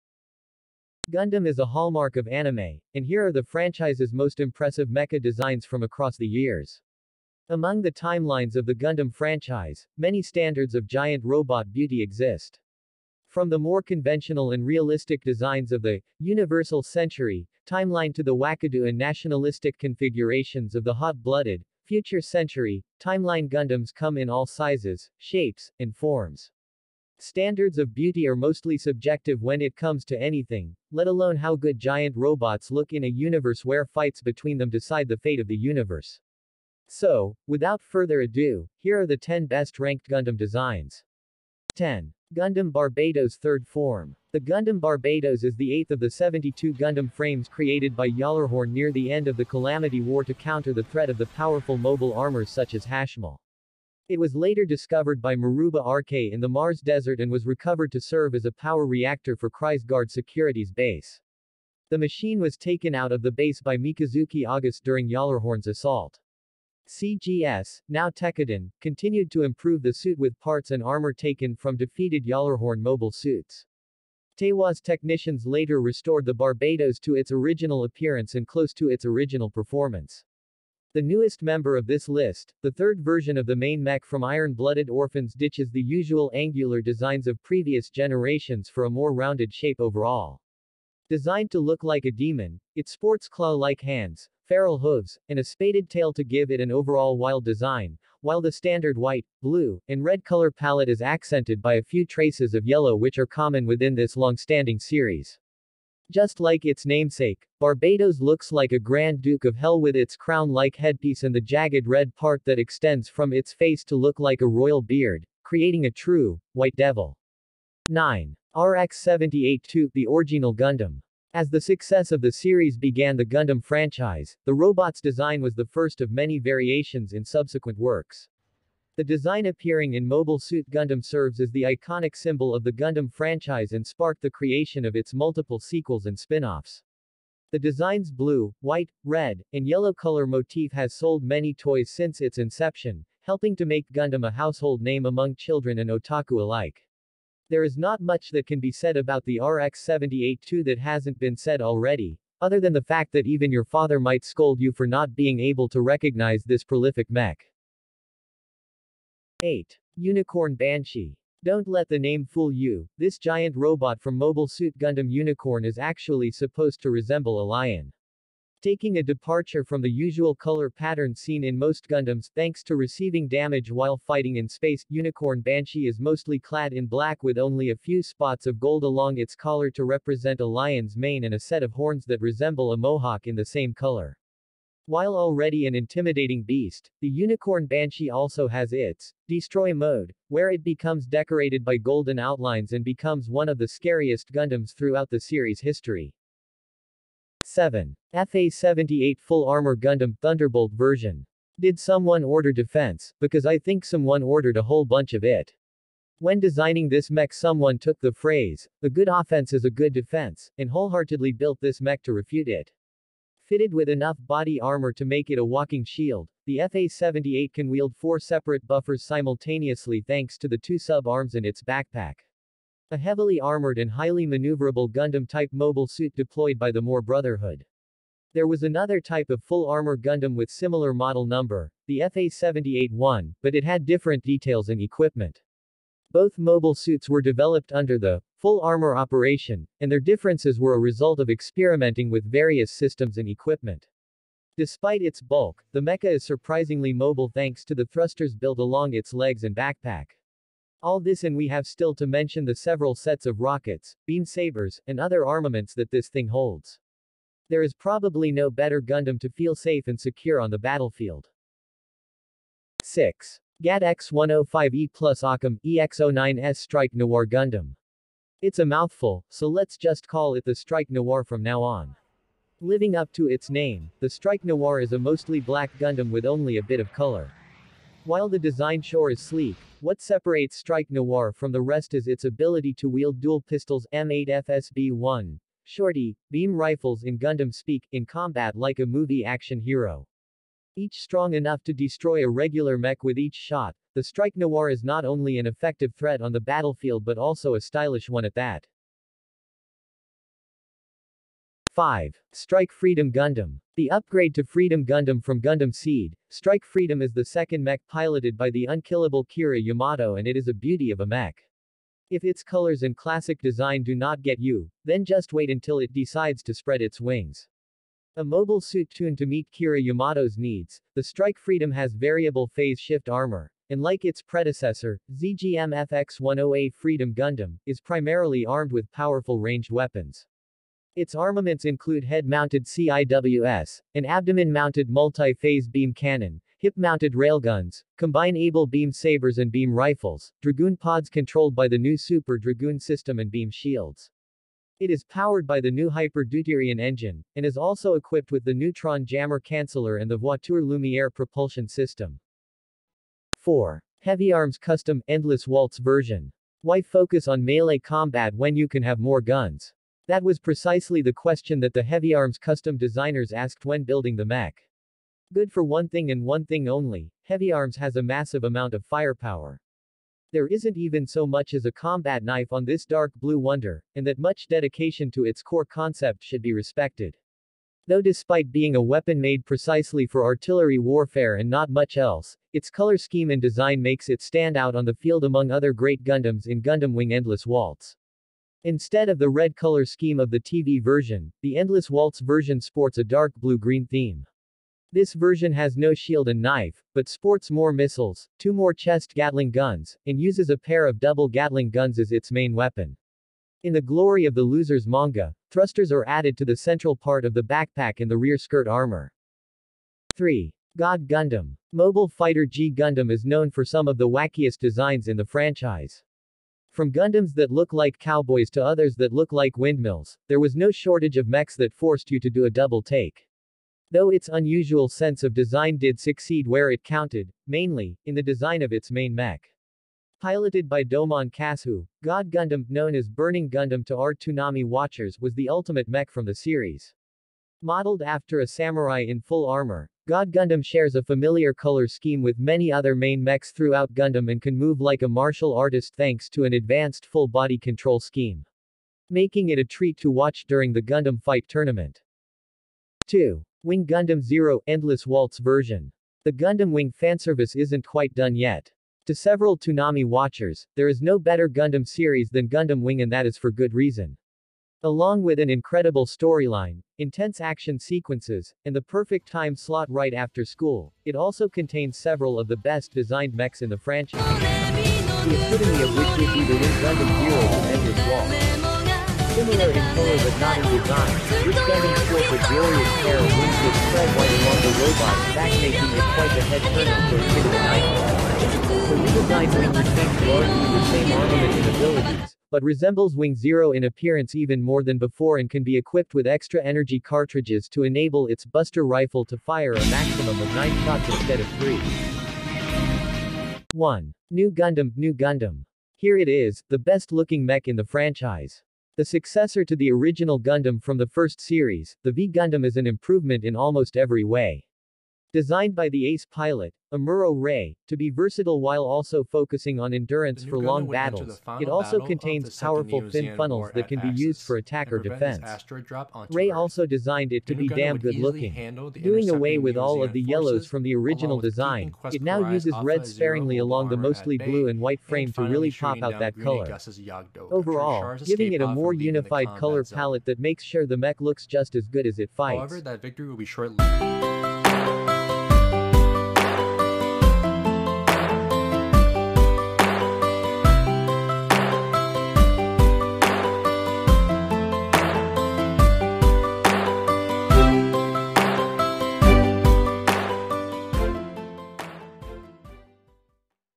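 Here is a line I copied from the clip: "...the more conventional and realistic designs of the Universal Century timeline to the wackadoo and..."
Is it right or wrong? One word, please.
right.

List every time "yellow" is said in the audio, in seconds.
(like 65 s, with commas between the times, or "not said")
102 s, 139 s, 530 s.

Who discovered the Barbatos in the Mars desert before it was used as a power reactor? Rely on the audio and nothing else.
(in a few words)
Maruba Arkay.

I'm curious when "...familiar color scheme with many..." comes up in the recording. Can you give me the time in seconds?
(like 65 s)
441 s.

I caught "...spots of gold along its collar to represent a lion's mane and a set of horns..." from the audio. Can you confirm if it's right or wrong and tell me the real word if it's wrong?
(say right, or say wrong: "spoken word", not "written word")
right.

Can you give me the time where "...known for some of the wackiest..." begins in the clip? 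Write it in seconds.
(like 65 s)
413 s.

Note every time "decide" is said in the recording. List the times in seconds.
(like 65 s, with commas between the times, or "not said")
34 s, 315 s.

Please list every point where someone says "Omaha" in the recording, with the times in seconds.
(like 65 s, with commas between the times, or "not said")
not said.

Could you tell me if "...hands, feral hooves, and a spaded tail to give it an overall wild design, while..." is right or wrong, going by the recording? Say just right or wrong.
right.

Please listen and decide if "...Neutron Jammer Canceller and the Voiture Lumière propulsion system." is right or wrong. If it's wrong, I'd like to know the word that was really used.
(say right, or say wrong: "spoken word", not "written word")
right.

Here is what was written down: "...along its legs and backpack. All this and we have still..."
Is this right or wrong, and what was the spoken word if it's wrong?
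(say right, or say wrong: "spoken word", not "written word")
right.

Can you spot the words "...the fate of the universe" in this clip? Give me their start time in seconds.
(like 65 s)
35 s.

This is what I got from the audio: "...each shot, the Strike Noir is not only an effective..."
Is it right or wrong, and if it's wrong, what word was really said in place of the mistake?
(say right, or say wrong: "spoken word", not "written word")
right.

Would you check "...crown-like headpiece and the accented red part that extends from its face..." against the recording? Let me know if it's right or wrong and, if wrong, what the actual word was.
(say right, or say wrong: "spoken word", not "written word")
wrong: "jagged", not "accented".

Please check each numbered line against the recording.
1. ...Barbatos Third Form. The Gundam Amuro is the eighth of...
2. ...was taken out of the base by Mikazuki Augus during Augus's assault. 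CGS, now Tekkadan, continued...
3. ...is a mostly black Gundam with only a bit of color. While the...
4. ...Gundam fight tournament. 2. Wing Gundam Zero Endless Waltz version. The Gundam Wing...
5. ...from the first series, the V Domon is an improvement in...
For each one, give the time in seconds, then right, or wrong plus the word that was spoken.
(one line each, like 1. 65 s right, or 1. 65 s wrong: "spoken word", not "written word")
1. 42 s wrong: "Barbatos", not "Amuro"
2. 62 s wrong: "Gjallarhorn", not "Augus"
3. 274 s right
4. 450 s right
5. 510 s wrong: "Gundam", not "Domon".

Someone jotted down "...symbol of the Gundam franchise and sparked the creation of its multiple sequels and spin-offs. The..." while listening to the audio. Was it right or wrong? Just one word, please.
right.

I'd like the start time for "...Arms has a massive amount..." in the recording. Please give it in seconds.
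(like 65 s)
367 s.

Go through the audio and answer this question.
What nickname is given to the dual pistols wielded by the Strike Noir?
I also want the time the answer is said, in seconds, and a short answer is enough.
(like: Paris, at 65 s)
Shorty, at 285 s.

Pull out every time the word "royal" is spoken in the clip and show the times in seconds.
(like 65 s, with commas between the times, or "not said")
114 s.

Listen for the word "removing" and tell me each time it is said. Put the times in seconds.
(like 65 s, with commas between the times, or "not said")
not said.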